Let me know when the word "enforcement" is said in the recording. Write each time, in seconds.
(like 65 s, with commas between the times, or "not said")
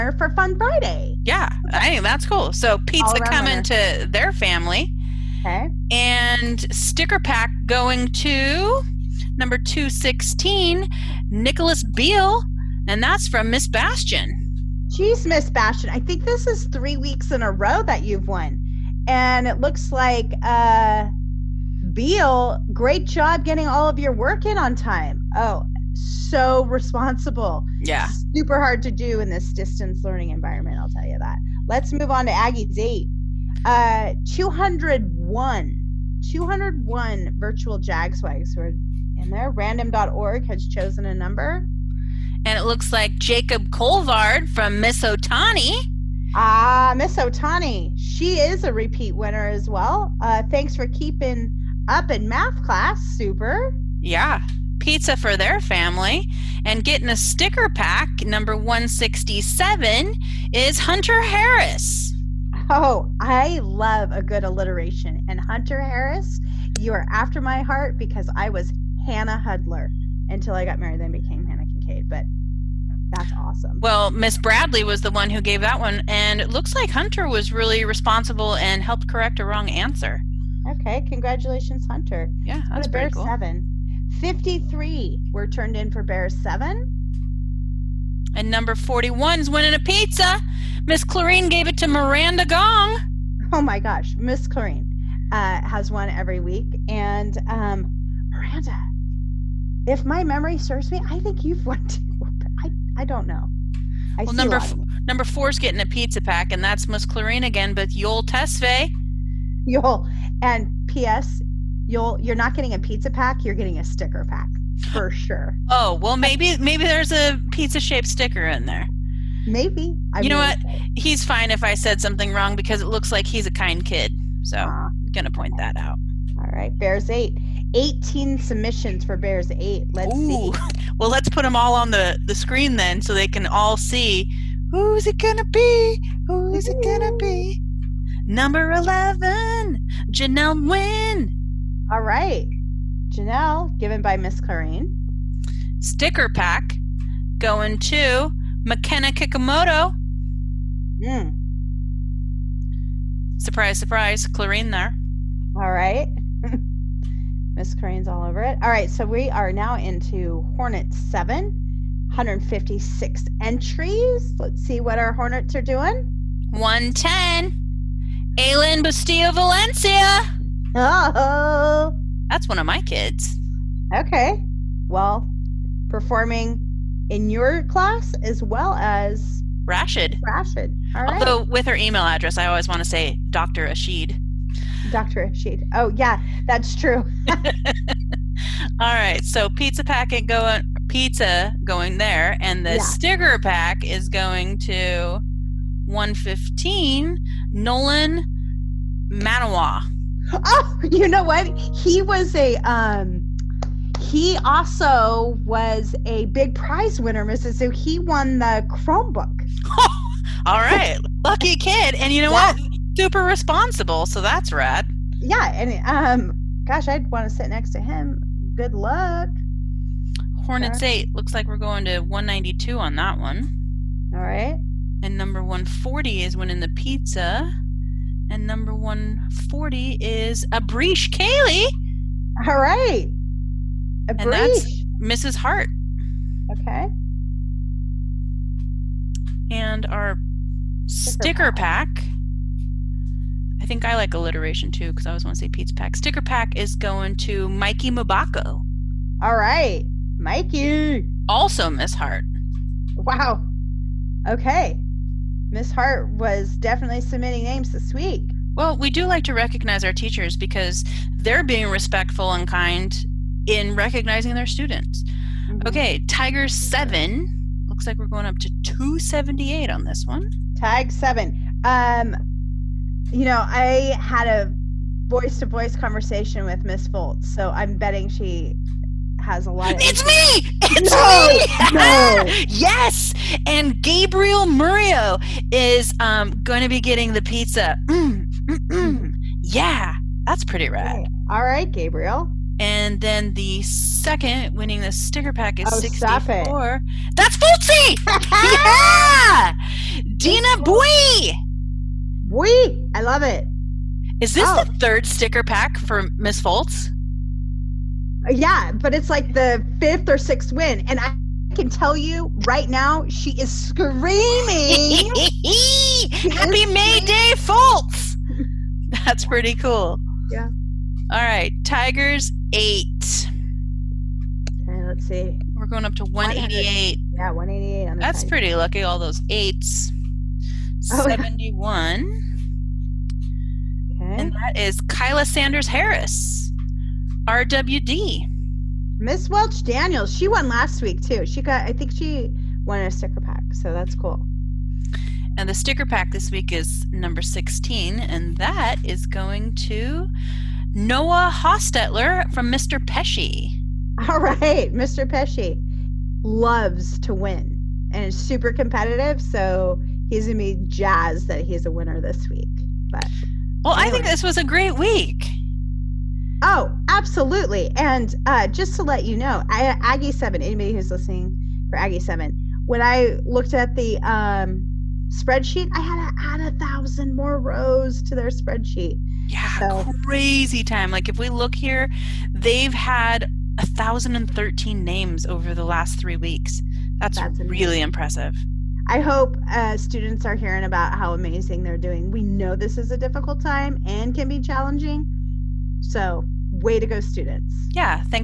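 not said.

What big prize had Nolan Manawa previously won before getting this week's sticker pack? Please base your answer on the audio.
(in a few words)
Chromebook.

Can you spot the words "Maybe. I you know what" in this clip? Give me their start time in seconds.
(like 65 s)
119 s.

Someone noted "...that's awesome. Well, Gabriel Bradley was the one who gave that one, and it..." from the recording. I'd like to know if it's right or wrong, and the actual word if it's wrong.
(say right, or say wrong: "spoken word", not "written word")
wrong: "Miss", not "Gabriel".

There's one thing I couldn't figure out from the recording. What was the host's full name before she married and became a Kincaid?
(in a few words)
Hannah Hudler.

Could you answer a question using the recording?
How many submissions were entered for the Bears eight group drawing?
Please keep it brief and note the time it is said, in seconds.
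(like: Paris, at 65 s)
18, at 127 s.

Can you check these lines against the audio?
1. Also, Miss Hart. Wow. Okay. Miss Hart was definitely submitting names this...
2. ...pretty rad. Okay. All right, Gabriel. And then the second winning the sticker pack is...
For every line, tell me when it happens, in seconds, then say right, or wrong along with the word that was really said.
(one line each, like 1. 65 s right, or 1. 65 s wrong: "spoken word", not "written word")
1. 251 s right
2. 290 s right.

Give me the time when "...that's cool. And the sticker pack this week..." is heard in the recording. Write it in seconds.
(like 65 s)
343 s.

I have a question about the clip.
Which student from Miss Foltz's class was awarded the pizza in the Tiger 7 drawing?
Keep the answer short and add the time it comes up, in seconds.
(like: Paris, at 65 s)
Gabriel Murillo, at 283 s.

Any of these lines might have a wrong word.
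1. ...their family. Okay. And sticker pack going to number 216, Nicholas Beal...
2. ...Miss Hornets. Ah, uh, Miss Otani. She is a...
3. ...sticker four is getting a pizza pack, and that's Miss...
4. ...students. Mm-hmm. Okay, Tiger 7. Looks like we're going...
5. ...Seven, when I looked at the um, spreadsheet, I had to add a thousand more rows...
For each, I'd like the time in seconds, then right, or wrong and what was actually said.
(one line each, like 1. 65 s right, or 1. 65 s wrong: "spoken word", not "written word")
1. 4 s right
2. 44 s wrong: "Otani", not "Hornets"
3. 105 s wrong: "number", not "sticker"
4. 264 s right
5. 371 s right.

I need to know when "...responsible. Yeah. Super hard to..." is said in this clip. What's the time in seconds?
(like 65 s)
26 s.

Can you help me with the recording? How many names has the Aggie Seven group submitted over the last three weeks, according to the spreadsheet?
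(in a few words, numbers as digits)
1,013.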